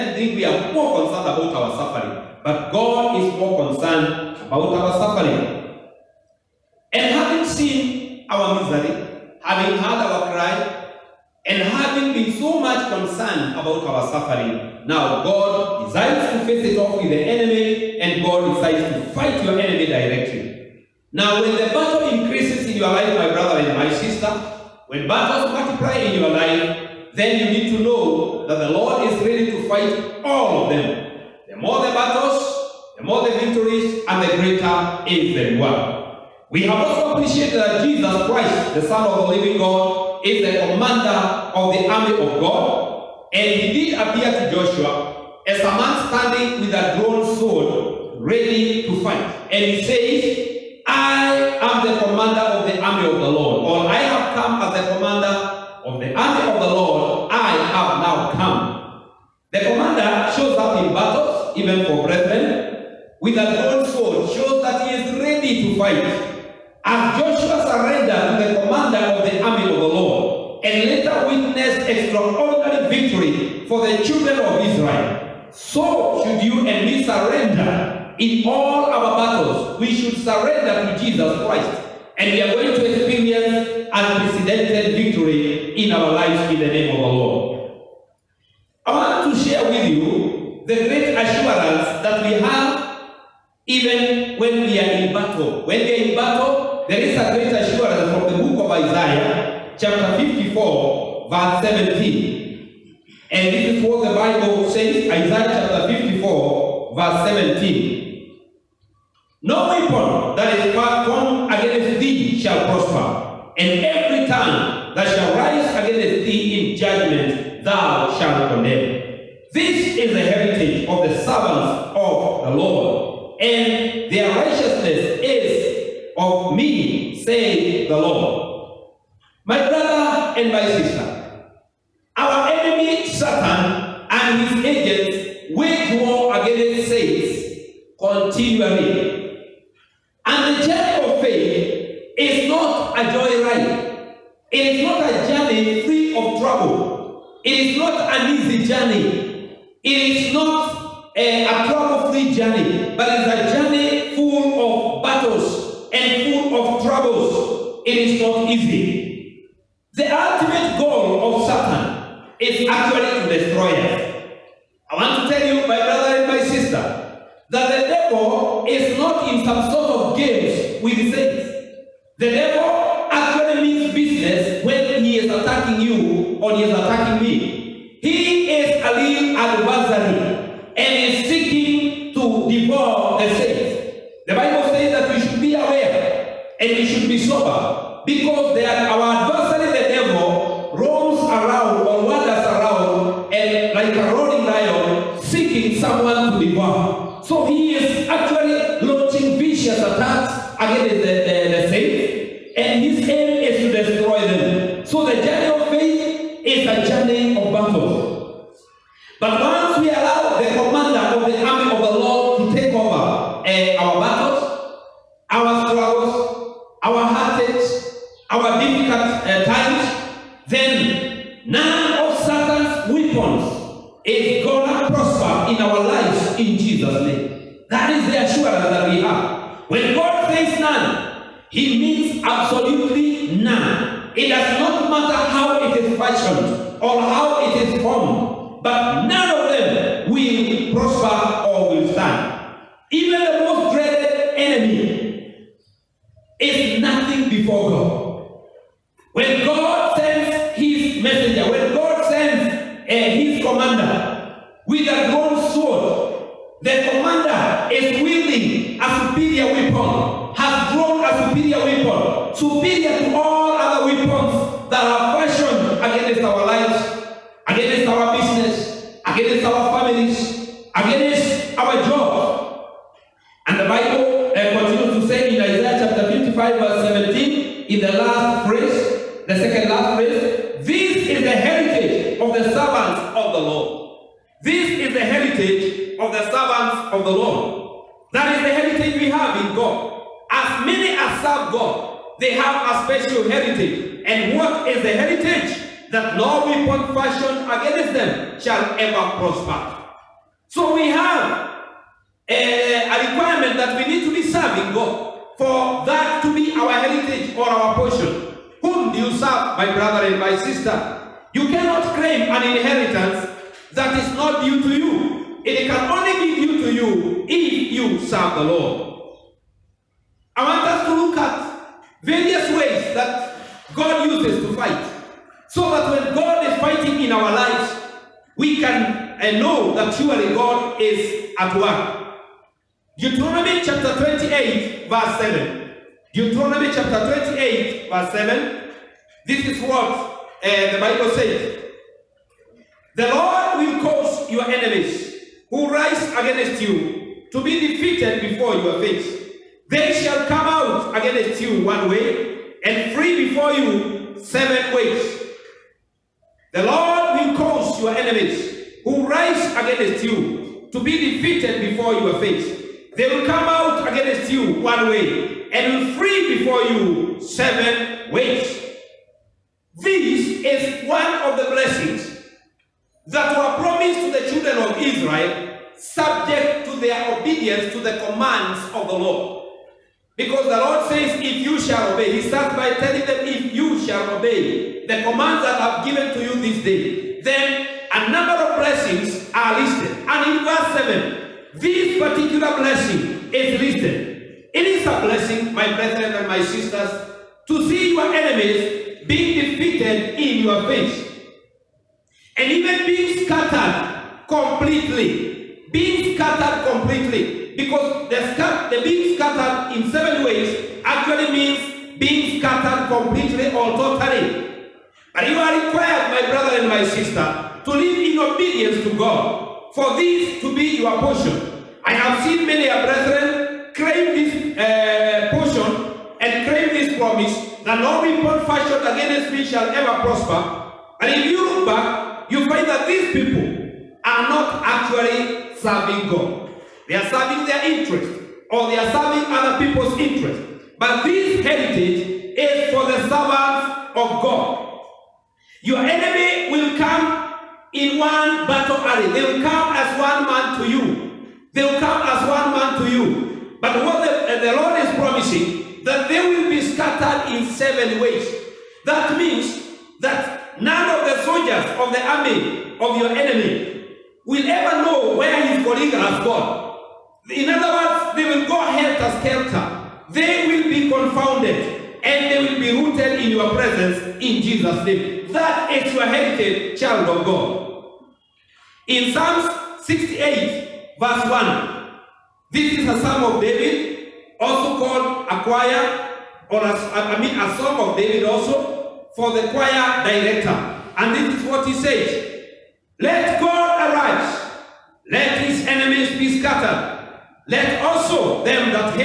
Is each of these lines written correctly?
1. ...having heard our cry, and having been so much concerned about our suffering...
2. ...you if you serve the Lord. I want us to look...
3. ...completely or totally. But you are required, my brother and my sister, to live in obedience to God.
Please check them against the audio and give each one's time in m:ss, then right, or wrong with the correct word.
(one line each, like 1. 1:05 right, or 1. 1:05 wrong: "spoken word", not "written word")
1. 0:09 right
2. 5:16 right
3. 6:52 right.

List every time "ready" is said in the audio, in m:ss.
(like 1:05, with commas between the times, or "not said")
0:29, 0:48, 1:05.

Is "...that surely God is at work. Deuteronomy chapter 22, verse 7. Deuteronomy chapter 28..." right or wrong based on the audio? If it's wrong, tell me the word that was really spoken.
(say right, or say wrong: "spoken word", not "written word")
wrong: "28", not "22".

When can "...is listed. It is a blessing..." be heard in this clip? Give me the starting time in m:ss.
6:33.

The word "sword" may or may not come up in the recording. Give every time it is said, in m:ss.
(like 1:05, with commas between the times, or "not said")
0:47, 1:03.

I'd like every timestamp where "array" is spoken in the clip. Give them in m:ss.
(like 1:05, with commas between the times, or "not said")
7:28.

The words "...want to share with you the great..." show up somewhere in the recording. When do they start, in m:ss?
1:28.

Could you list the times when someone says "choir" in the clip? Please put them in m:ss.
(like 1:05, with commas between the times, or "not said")
8:05, 8:09.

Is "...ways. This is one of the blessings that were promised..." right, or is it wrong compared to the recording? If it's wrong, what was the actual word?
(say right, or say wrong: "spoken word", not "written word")
right.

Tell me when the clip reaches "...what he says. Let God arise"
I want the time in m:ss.
8:11.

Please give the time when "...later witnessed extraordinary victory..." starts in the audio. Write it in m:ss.
1:10.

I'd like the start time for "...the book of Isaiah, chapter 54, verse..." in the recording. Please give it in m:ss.
1:38.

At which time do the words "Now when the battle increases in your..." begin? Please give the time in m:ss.
0:21.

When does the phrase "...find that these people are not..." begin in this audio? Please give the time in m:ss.
7:12.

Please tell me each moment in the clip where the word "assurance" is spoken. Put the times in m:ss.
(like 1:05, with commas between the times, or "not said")
1:31, 1:37.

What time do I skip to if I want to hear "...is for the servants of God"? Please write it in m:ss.
7:22.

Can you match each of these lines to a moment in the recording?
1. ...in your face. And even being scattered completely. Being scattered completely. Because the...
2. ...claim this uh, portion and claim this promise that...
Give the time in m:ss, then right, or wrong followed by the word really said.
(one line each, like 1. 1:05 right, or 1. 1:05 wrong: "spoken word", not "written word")
1. 6:40 right
2. 7:03 right.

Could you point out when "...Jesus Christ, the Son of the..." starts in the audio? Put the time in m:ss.
0:37.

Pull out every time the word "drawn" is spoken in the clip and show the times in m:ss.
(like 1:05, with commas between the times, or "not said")
0:47, 1:03.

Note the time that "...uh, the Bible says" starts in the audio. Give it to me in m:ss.
5:40.